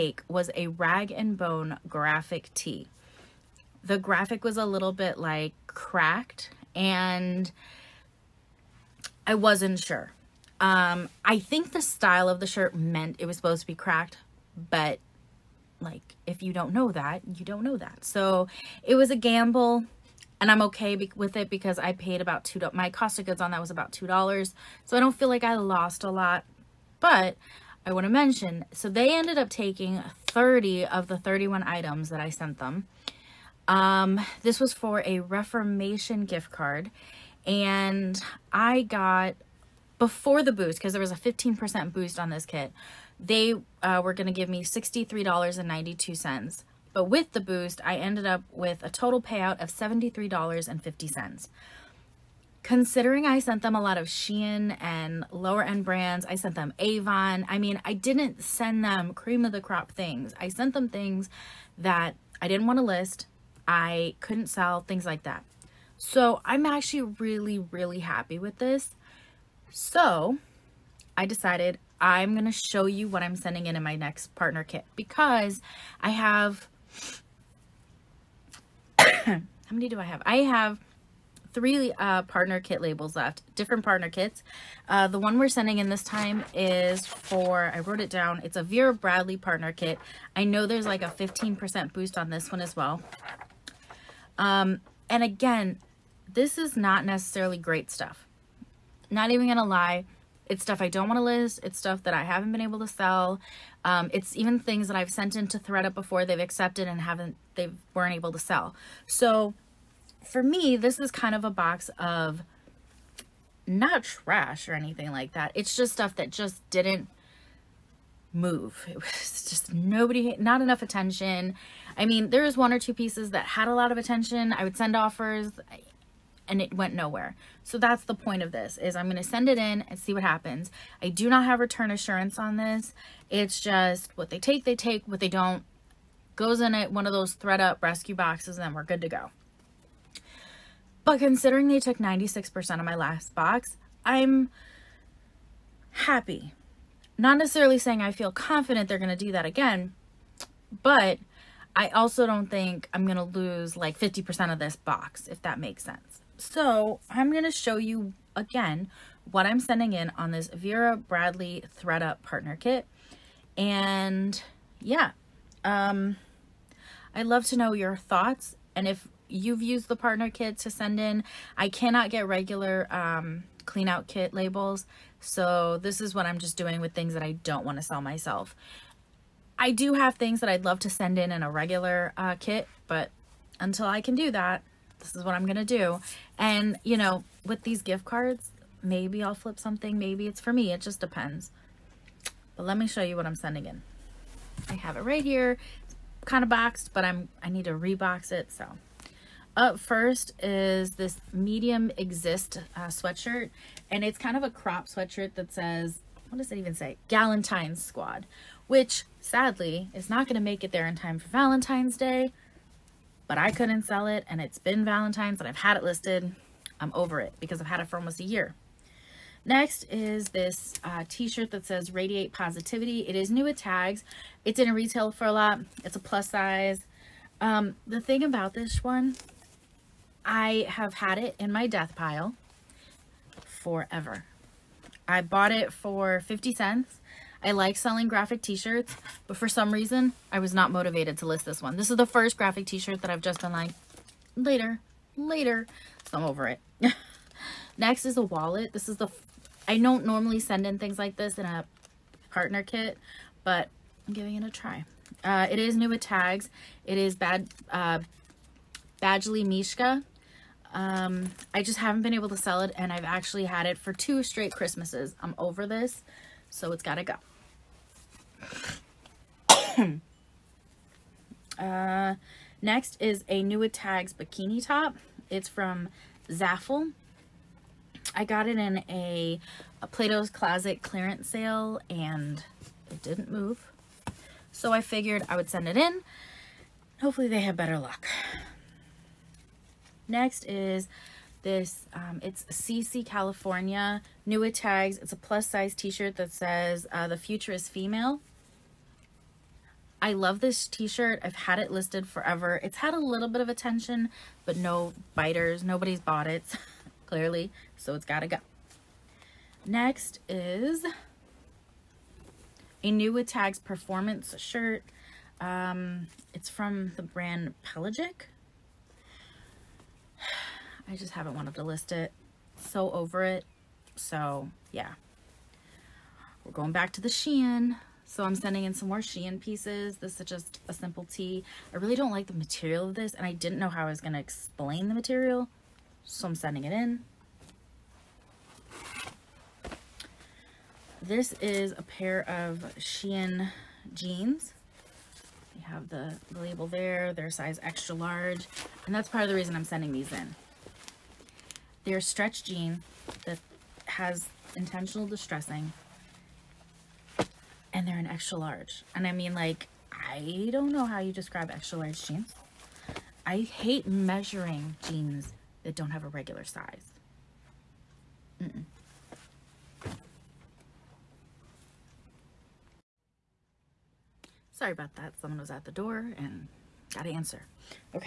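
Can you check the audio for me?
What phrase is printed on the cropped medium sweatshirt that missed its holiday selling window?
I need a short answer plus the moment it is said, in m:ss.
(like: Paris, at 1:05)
Galentine's Squad, at 3:27.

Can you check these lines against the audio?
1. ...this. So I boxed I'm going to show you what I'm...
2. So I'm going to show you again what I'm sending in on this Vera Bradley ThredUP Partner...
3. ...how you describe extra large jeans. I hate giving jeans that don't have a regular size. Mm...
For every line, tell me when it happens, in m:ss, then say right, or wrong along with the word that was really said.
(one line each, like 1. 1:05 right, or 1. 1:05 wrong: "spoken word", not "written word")
1. 1:08 wrong: "decided", not "boxed"
2. 2:36 right
3. 6:00 wrong: "measuring", not "giving".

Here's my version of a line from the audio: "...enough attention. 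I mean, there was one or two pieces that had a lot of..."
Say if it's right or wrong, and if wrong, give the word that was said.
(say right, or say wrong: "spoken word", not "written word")
right.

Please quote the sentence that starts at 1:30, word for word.
I know there's like a 15% boost on this one as well.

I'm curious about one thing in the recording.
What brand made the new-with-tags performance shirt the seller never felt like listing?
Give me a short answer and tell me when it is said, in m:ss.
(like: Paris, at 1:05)
Pelagic, at 5:17.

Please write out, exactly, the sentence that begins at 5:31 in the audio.
I really don't like the material of this and I didn't know how I was going to explain the material.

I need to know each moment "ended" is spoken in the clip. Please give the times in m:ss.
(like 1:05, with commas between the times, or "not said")
0:29, 0:47.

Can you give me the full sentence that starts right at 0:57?
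I mean, I didn't send them cream of the crop things.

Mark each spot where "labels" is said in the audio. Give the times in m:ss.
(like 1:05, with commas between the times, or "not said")
1:22, 2:54, 5:46.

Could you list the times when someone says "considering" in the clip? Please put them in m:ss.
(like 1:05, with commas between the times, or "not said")
0:52, 2:21.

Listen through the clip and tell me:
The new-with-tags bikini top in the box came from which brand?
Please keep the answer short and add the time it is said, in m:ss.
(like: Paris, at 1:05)
Zaful, at 4:36.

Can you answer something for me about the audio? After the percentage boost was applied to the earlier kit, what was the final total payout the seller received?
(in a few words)
$73.50.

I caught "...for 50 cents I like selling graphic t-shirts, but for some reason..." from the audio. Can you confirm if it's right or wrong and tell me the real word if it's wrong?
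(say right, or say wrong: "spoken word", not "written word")
right.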